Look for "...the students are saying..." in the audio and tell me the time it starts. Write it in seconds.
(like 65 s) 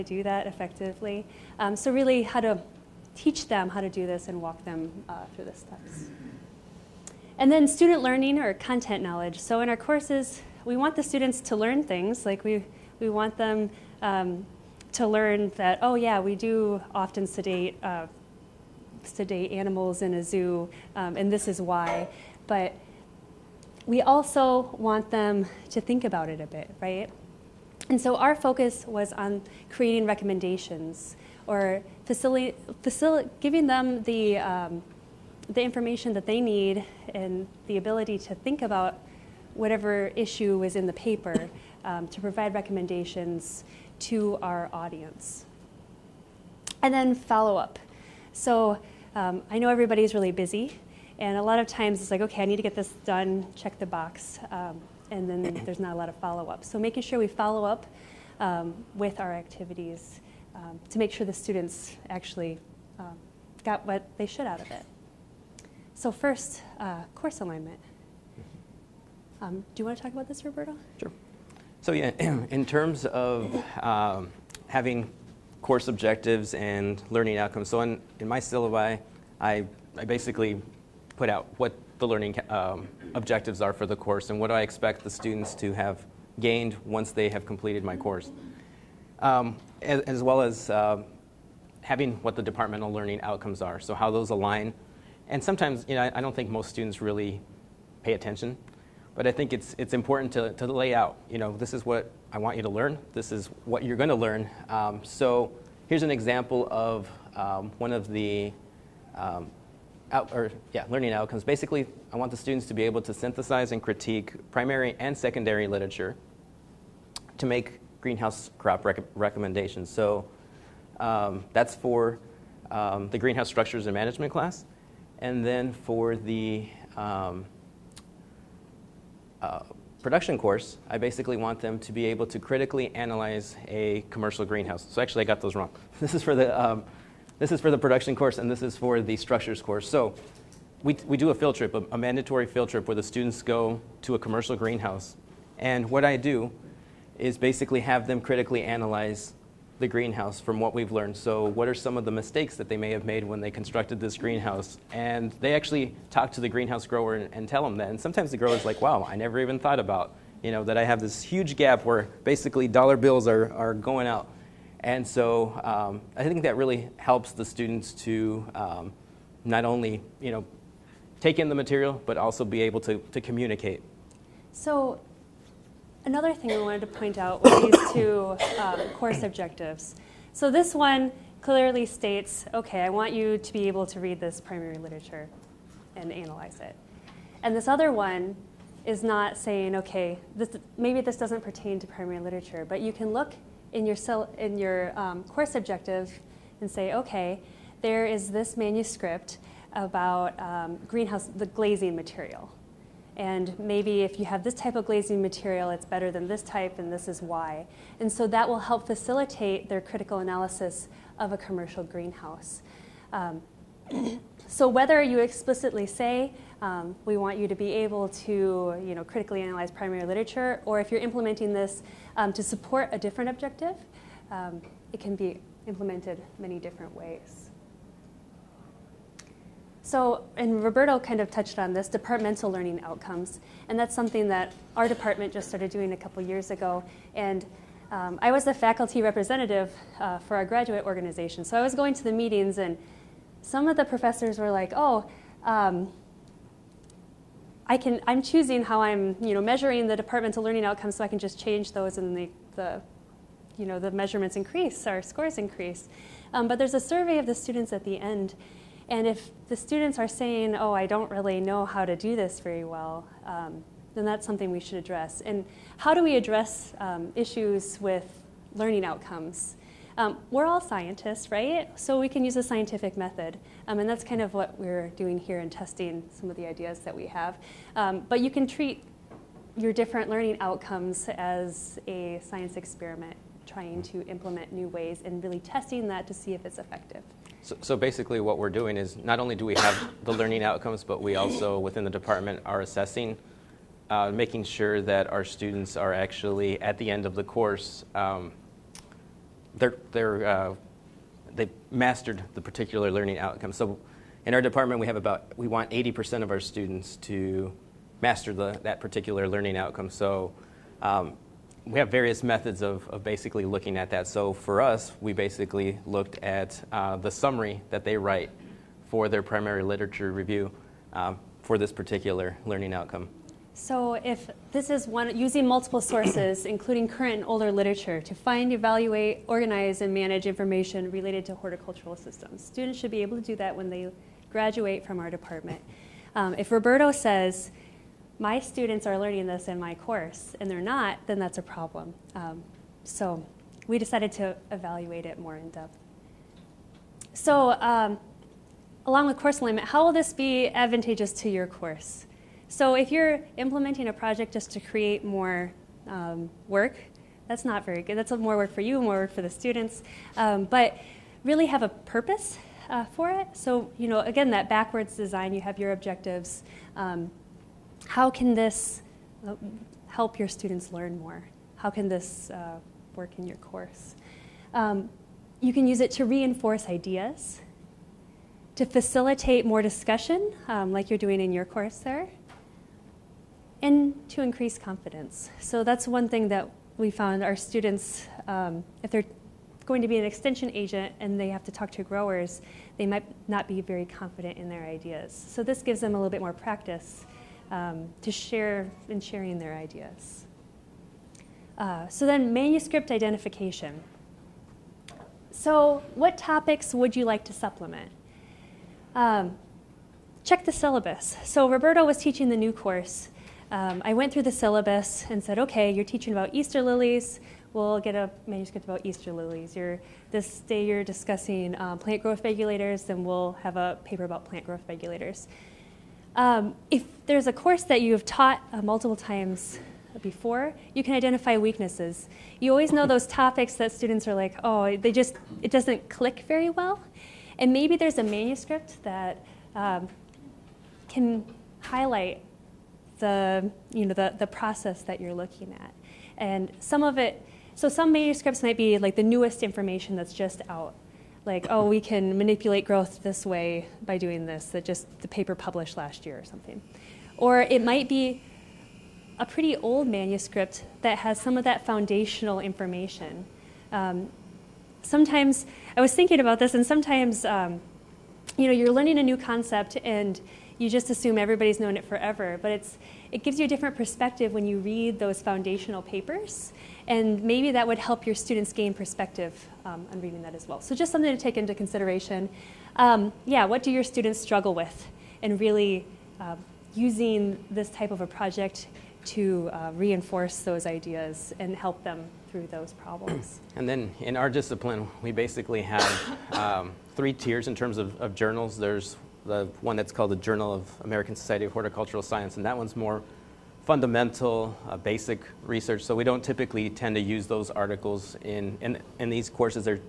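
259 s.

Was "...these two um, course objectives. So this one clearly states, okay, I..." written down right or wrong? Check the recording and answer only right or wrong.
right.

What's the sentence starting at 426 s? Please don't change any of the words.
Um, if there's a course that you've taught uh, multiple times before, you can identify weaknesses.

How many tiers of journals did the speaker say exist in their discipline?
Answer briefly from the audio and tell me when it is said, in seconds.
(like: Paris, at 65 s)
3, at 496 s.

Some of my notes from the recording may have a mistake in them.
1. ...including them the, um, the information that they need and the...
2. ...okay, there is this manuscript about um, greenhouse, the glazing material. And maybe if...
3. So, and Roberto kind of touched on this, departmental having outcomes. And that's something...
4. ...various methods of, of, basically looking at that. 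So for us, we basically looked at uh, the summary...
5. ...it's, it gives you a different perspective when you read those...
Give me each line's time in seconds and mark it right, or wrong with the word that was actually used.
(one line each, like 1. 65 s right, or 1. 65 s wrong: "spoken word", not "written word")
1. 33 s wrong: "giving", not "including"
2. 196 s right
3. 229 s wrong: "learning", not "having"
4. 311 s right
5. 472 s right.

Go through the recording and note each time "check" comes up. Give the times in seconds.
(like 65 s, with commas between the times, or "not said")
53 s, 410 s.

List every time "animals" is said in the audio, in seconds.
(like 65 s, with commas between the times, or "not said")
19 s.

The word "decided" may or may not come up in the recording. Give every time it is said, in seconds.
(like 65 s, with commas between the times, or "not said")
343 s.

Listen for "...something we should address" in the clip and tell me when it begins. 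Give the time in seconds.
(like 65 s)
264 s.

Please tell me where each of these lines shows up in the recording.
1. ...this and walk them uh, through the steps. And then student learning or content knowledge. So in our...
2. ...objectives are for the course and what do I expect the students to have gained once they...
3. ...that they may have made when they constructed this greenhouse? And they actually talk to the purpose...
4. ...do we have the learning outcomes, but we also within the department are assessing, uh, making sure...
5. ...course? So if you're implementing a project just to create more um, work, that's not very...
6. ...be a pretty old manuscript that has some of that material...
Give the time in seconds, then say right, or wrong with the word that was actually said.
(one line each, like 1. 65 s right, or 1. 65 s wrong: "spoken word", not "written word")
1. 4 s right
2. 83 s right
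3. 152 s wrong: "greenhouse", not "purpose"
4. 289 s right
5. 351 s right
6. 457 s wrong: "foundational", not "material".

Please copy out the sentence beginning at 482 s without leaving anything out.
Um, yeah, what do your students struggle with?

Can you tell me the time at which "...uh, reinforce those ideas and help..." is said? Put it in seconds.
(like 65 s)
489 s.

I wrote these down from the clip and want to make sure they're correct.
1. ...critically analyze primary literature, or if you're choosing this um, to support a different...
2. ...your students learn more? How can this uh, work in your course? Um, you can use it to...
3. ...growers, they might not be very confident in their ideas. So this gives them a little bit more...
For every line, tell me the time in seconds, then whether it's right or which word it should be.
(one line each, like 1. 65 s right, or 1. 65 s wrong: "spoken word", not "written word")
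1. 219 s wrong: "implementing", not "choosing"
2. 370 s right
3. 391 s right.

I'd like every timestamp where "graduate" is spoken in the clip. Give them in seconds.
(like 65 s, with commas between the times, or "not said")
240 s, 334 s.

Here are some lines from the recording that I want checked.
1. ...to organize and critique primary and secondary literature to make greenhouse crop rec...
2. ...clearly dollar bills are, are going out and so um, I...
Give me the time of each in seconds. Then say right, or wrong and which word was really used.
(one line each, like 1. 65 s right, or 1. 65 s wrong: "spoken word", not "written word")
1. 113 s wrong: "synthesize", not "organize"
2. 162 s wrong: "basically", not "clearly".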